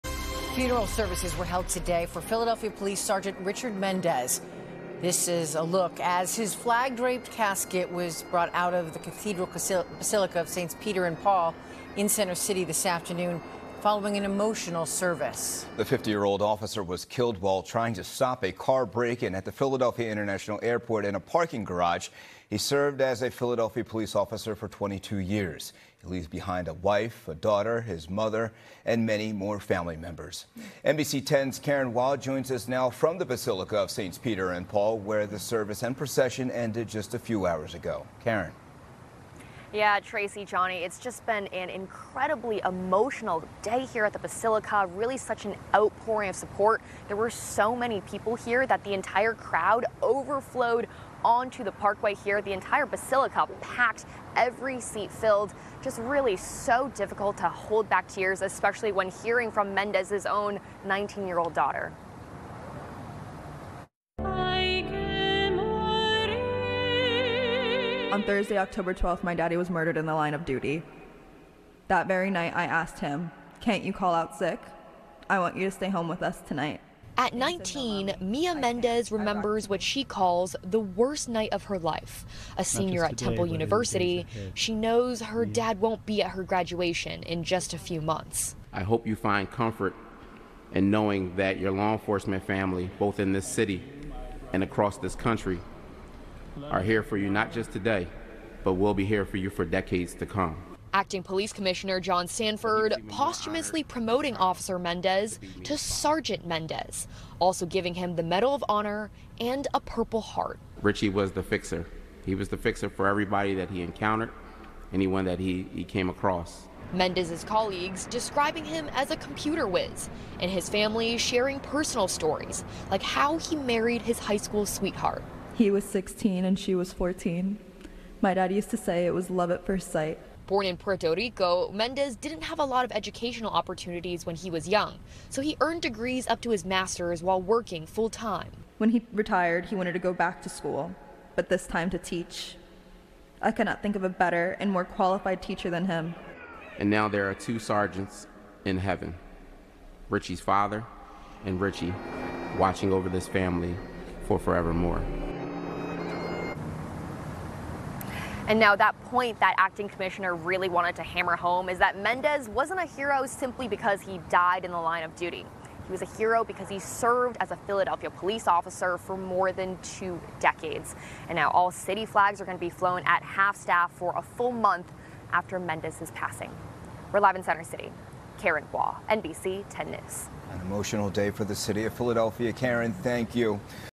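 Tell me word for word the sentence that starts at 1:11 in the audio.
That very night, I asked him, Can't you call out sick?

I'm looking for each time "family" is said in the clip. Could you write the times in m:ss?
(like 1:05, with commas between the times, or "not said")
0:29, 1:32, 2:00, 2:33.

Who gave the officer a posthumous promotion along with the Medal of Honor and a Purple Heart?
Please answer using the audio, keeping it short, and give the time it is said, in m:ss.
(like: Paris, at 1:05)
John Stanford, at 1:42.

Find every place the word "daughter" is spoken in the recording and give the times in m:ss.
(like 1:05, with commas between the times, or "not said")
0:27, 1:01.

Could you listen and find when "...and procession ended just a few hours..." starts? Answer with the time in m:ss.
0:35.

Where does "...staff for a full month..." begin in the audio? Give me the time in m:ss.
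2:53.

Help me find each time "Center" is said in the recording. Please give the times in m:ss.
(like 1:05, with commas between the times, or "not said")
0:12, 2:57.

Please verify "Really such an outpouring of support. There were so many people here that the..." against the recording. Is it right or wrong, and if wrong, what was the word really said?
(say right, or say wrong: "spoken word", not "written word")
right.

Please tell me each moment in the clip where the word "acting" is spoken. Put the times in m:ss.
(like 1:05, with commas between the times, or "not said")
1:40, 2:39.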